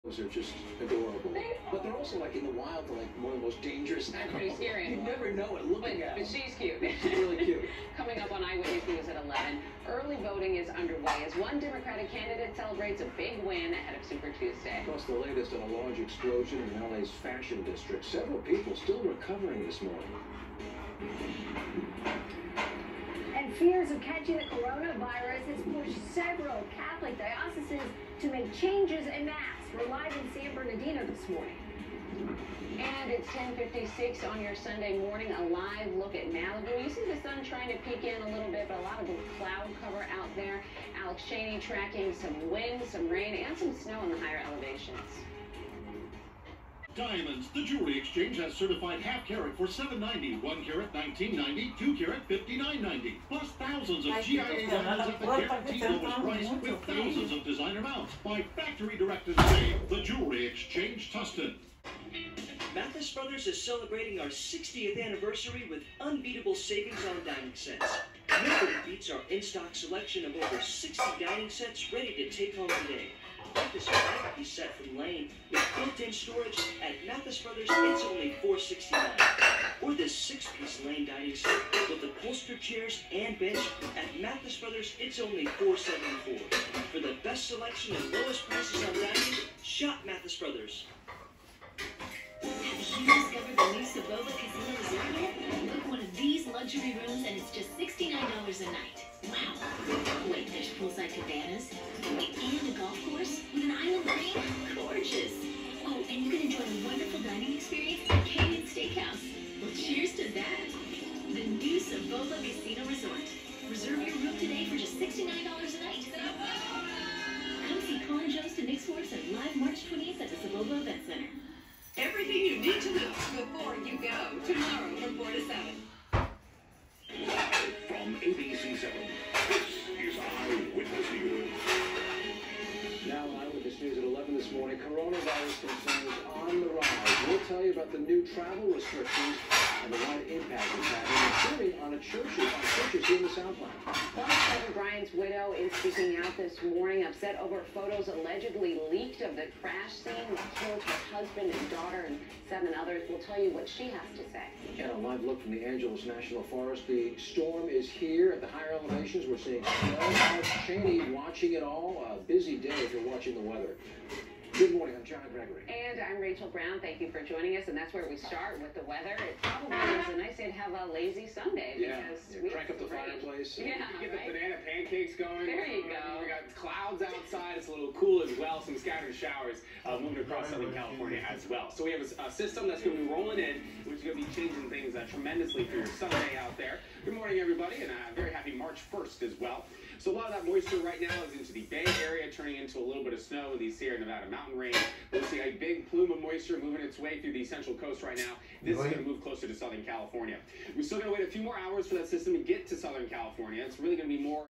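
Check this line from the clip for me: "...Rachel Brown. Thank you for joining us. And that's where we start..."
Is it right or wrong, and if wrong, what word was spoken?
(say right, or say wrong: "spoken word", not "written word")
right.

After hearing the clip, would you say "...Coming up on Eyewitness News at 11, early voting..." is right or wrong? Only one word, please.
right.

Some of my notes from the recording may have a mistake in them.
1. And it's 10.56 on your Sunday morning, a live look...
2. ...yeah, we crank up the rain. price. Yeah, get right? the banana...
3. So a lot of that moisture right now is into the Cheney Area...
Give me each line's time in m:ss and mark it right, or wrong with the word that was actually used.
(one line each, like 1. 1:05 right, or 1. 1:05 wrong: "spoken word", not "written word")
1. 0:32 right
2. 2:52 wrong: "fireplace", not "price"
3. 3:09 wrong: "Bay", not "Cheney".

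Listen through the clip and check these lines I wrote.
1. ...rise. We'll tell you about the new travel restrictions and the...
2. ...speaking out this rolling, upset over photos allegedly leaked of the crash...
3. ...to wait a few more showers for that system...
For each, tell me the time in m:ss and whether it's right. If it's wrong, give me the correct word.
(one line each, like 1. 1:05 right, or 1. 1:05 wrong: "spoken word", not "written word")
1. 2:16 right
2. 2:25 wrong: "morning", not "rolling"
3. 3:21 wrong: "hours", not "showers".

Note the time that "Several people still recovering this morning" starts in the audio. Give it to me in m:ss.
0:18.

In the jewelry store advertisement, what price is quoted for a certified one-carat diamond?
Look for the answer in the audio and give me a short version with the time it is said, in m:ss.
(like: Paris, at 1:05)
$1,990, at 0:50.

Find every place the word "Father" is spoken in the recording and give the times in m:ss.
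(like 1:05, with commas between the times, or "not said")
2:23.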